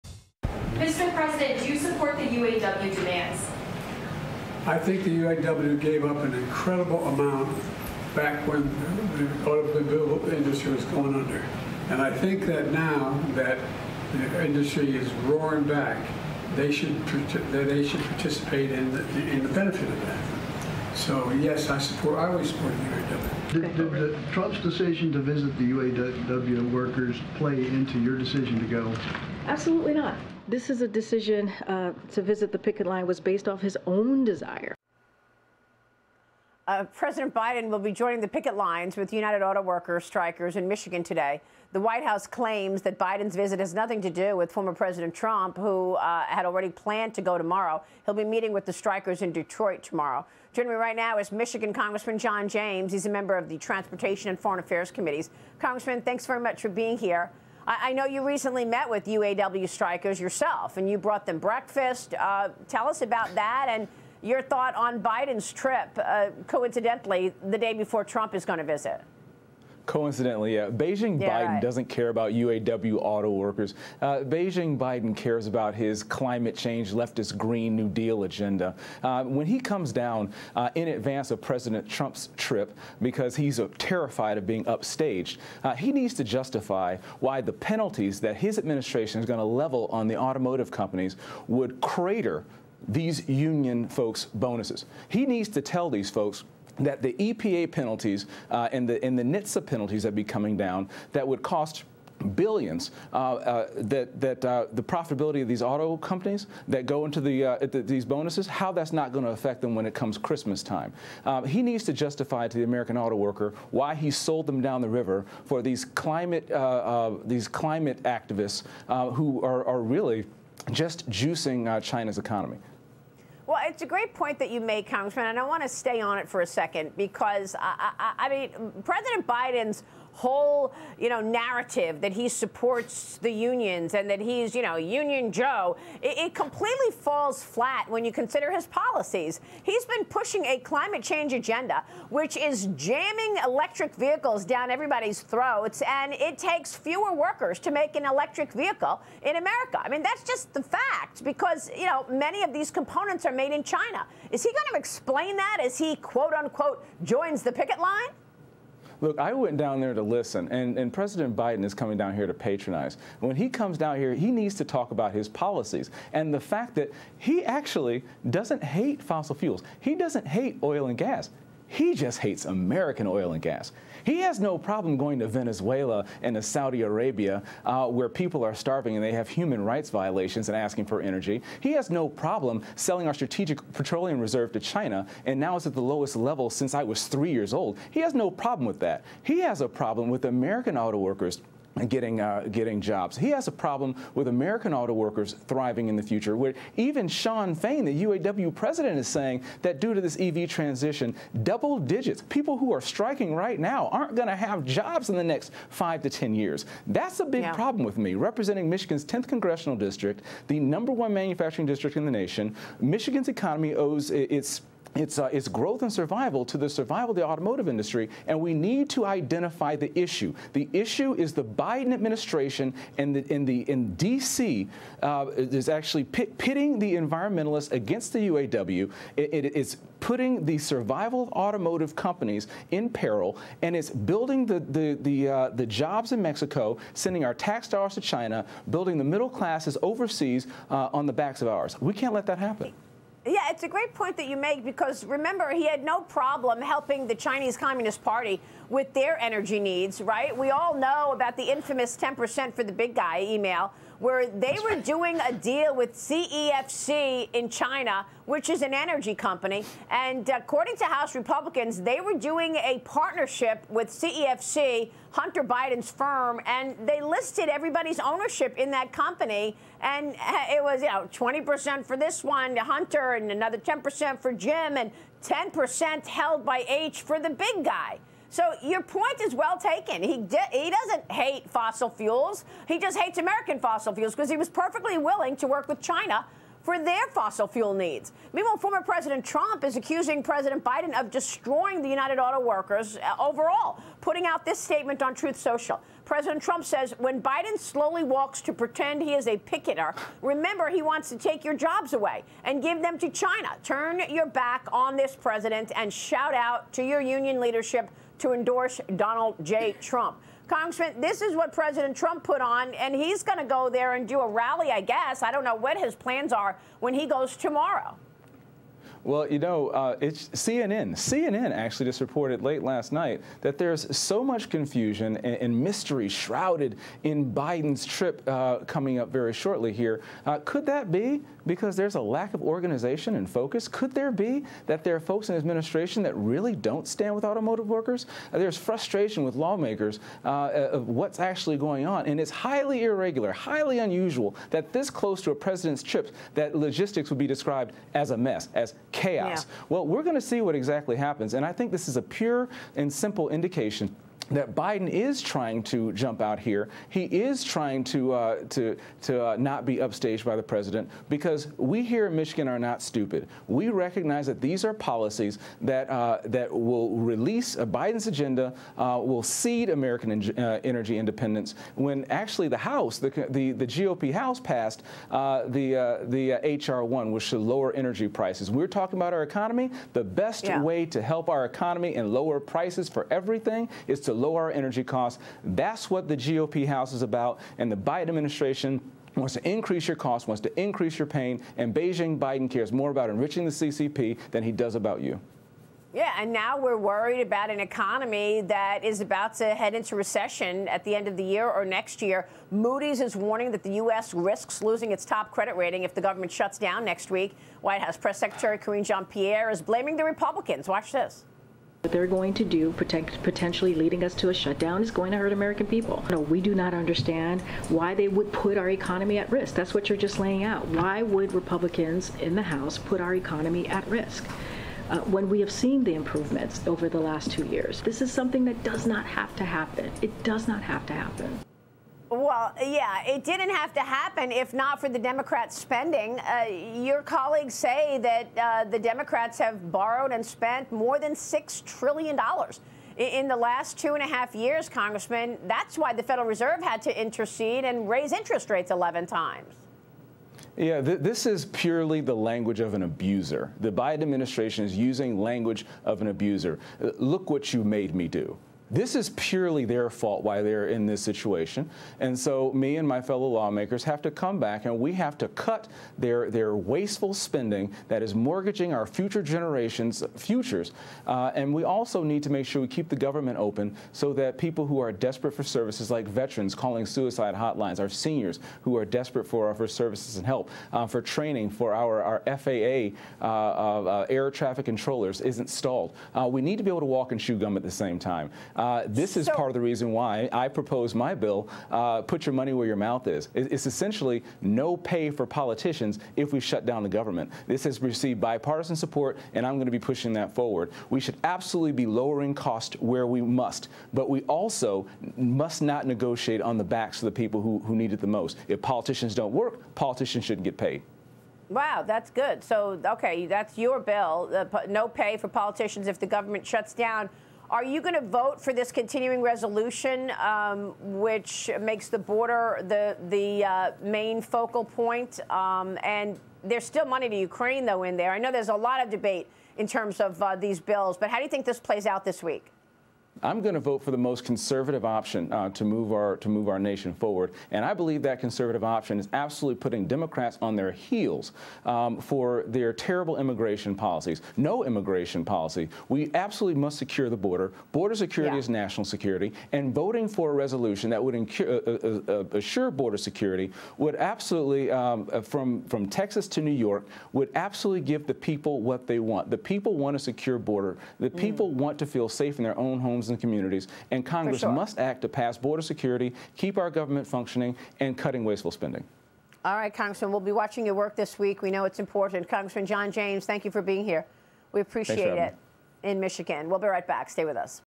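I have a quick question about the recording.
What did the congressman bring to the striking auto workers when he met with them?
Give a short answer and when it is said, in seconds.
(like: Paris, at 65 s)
breakfast, at 61 s.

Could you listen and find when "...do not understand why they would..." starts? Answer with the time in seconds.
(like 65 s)
416 s.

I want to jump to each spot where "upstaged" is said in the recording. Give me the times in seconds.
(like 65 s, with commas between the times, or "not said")
84 s, 359 s.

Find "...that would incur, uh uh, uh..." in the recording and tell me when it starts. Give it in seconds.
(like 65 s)
550 s.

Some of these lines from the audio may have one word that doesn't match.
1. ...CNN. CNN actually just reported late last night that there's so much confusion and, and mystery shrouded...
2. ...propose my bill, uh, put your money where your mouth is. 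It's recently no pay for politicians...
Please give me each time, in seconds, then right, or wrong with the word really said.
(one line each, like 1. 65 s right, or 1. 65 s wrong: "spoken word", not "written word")
1. 320 s right
2. 490 s wrong: "essentially", not "recently".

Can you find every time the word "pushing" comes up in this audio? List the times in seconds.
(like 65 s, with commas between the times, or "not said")
140 s, 499 s.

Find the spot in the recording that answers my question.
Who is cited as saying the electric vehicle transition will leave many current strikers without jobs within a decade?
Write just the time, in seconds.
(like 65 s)
197 s.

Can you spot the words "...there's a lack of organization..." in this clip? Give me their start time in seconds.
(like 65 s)
331 s.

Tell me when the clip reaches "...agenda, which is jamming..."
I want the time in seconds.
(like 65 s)
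141 s.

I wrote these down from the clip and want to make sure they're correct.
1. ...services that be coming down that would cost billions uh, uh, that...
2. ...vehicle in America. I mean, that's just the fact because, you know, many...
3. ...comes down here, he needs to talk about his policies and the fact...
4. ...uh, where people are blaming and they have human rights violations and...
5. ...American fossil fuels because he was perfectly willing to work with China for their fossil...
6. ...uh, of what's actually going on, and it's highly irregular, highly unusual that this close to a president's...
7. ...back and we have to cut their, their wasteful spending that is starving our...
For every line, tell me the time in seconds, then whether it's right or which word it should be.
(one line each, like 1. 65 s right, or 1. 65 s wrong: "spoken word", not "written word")
1. 99 s wrong: "penalties", not "services"
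2. 148 s right
3. 163 s right
4. 177 s wrong: "starving", not "blaming"
5. 283 s right
6. 340 s right
7. 464 s wrong: "mortgaging", not "starving".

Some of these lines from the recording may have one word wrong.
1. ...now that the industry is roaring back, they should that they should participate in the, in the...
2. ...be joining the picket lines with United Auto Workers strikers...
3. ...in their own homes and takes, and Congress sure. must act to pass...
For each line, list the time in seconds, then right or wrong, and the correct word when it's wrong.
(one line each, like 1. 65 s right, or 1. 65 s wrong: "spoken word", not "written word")
1. 12 s right
2. 37 s right
3. 562 s wrong: "communities", not "takes".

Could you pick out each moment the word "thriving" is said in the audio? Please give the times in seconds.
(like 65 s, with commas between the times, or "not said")
195 s.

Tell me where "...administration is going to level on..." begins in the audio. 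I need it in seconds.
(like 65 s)
88 s.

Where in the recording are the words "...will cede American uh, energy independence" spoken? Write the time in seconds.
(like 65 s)
369 s.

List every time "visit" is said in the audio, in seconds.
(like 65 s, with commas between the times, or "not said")
25 s, 32 s, 43 s, 68 s.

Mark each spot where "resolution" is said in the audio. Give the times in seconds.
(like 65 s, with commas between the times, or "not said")
519 s, 550 s.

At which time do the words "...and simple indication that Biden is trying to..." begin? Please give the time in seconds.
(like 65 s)
352 s.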